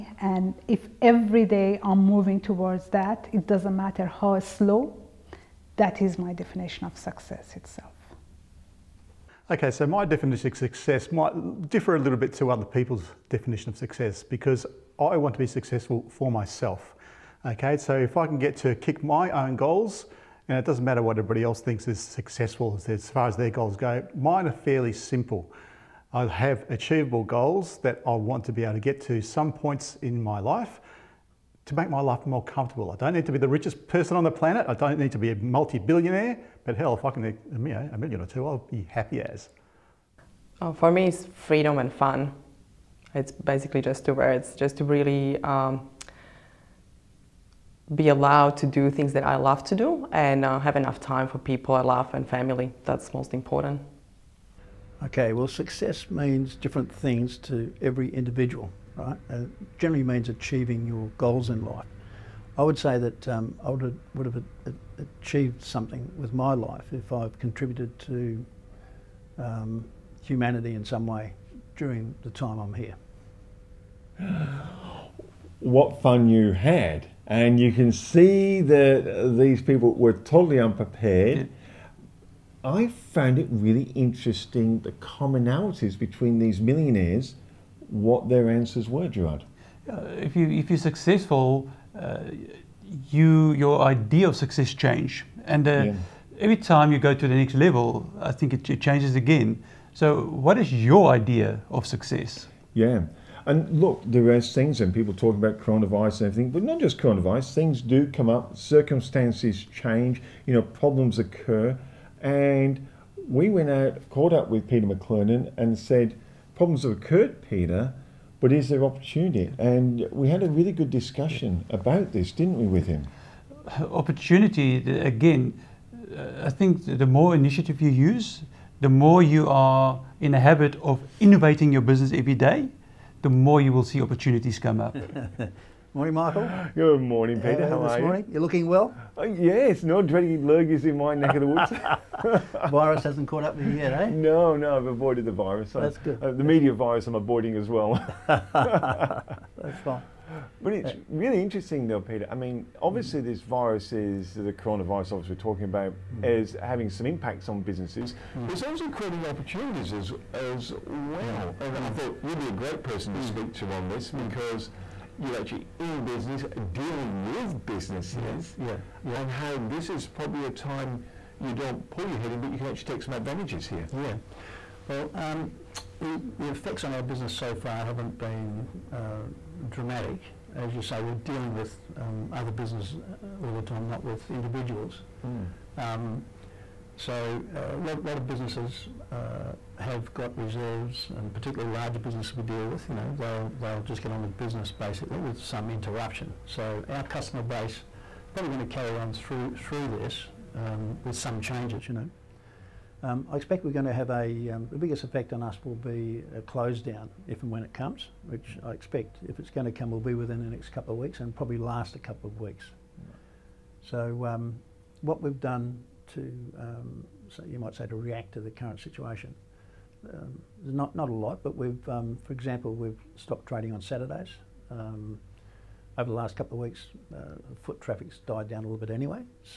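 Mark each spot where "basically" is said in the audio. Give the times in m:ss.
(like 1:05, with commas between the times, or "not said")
0:43, 3:14.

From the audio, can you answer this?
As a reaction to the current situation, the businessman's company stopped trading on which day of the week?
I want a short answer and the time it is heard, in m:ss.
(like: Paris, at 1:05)
Saturdays, at 3:43.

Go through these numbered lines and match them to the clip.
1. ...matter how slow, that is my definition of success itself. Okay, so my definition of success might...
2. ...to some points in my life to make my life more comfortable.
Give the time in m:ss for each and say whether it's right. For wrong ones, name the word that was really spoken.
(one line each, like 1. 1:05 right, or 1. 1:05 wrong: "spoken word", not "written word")
1. 0:03 right
2. 0:29 right.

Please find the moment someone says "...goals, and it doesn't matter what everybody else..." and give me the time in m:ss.
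0:19.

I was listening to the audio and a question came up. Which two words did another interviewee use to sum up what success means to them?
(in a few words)
freedom and fun.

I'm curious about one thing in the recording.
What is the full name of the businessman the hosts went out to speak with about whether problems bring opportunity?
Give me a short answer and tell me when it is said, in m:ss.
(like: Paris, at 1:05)
Peter McLernon, at 1:54.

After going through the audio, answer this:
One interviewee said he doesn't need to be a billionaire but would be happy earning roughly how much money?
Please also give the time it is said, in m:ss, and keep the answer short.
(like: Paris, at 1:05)
a million or two, at 0:37.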